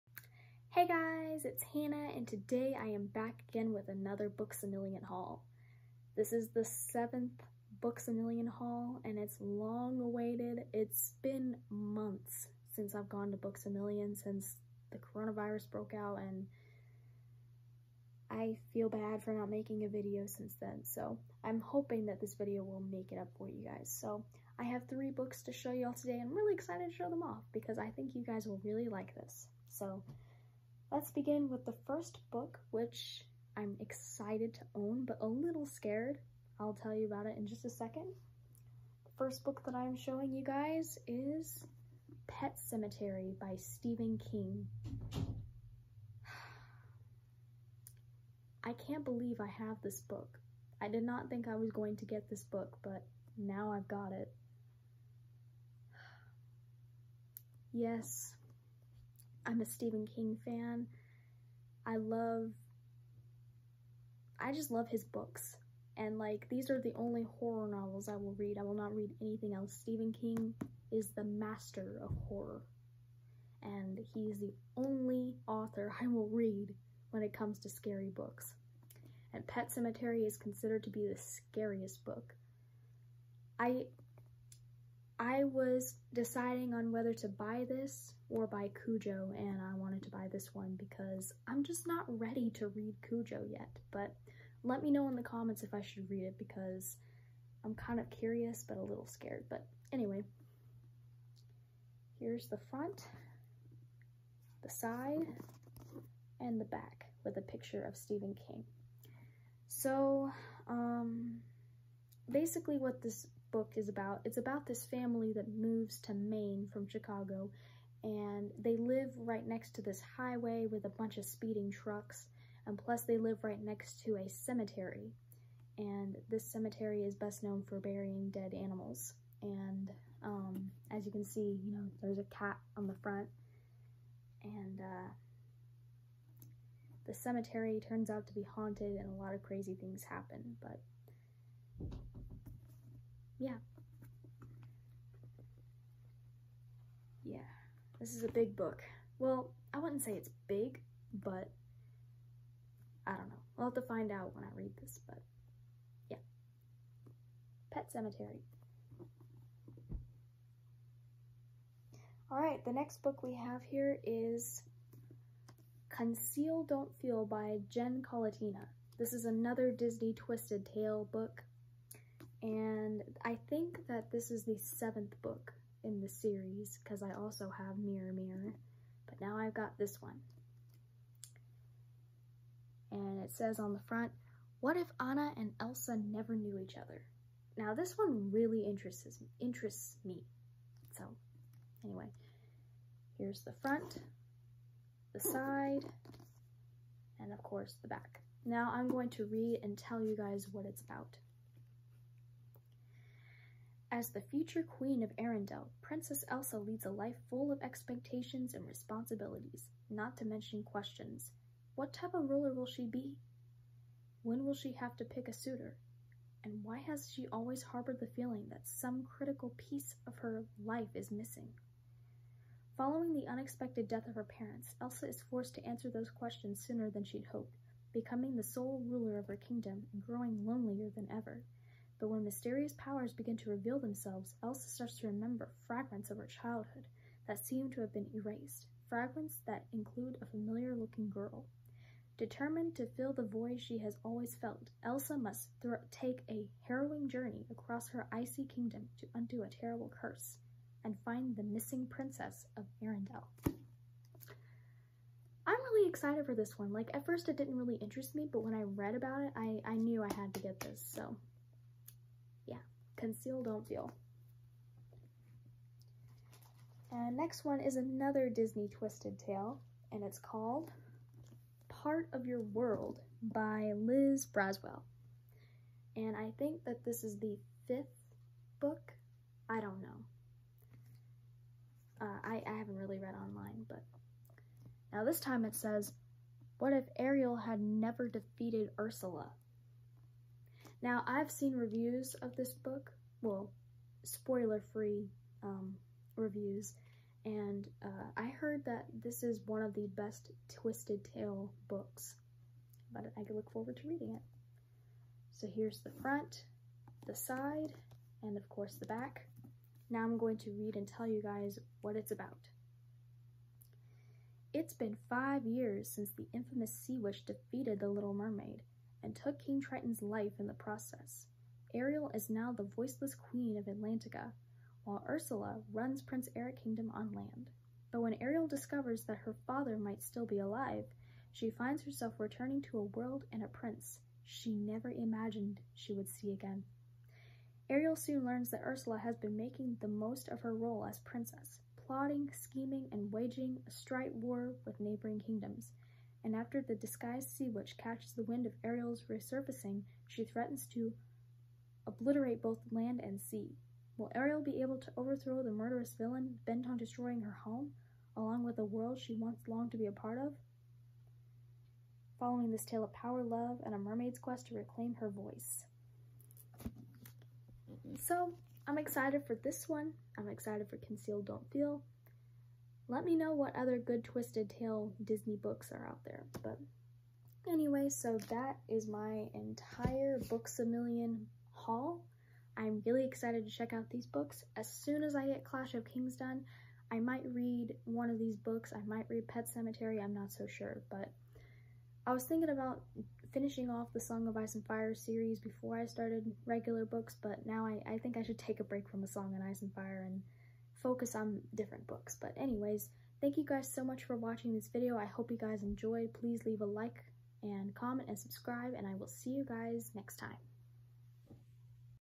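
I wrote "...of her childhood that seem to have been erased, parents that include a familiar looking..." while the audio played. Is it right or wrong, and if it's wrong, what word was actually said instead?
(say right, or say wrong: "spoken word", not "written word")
wrong: "fragments", not "parents".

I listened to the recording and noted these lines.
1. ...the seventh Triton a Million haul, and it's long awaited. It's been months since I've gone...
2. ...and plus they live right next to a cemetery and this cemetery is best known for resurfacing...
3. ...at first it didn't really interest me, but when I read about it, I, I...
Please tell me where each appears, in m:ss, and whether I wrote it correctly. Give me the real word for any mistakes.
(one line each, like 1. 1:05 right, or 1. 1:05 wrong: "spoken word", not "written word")
1. 0:06 wrong: "Books", not "Triton"
2. 2:02 wrong: "burying", not "resurfacing"
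3. 4:16 right.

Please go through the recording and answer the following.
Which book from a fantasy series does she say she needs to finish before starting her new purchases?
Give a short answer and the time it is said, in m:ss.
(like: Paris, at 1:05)
Clash of Kings, at 6:25.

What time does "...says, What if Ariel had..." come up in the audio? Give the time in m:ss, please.
4:45.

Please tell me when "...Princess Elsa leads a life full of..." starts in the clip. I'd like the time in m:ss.
3:25.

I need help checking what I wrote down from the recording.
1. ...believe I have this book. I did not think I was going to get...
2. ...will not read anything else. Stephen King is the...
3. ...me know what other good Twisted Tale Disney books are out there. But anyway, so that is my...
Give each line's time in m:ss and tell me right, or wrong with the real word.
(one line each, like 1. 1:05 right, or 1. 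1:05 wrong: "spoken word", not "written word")
1. 0:49 right
2. 1:08 right
3. 6:13 right.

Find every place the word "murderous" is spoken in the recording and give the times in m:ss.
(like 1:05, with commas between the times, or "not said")
5:55.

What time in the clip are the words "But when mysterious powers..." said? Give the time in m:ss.
3:52.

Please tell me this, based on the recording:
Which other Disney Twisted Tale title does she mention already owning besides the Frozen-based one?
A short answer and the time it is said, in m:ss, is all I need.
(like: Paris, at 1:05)
Mirror Mirror, at 2:57.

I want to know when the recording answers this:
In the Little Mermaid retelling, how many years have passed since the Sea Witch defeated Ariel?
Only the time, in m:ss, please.
5:15.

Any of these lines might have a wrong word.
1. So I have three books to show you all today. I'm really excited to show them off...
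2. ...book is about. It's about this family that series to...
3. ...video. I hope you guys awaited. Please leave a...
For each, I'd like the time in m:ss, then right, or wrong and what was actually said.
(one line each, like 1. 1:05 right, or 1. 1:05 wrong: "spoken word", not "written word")
1. 0:23 right
2. 1:53 wrong: "moves", not "series"
3. 6:44 wrong: "enjoyed", not "awaited".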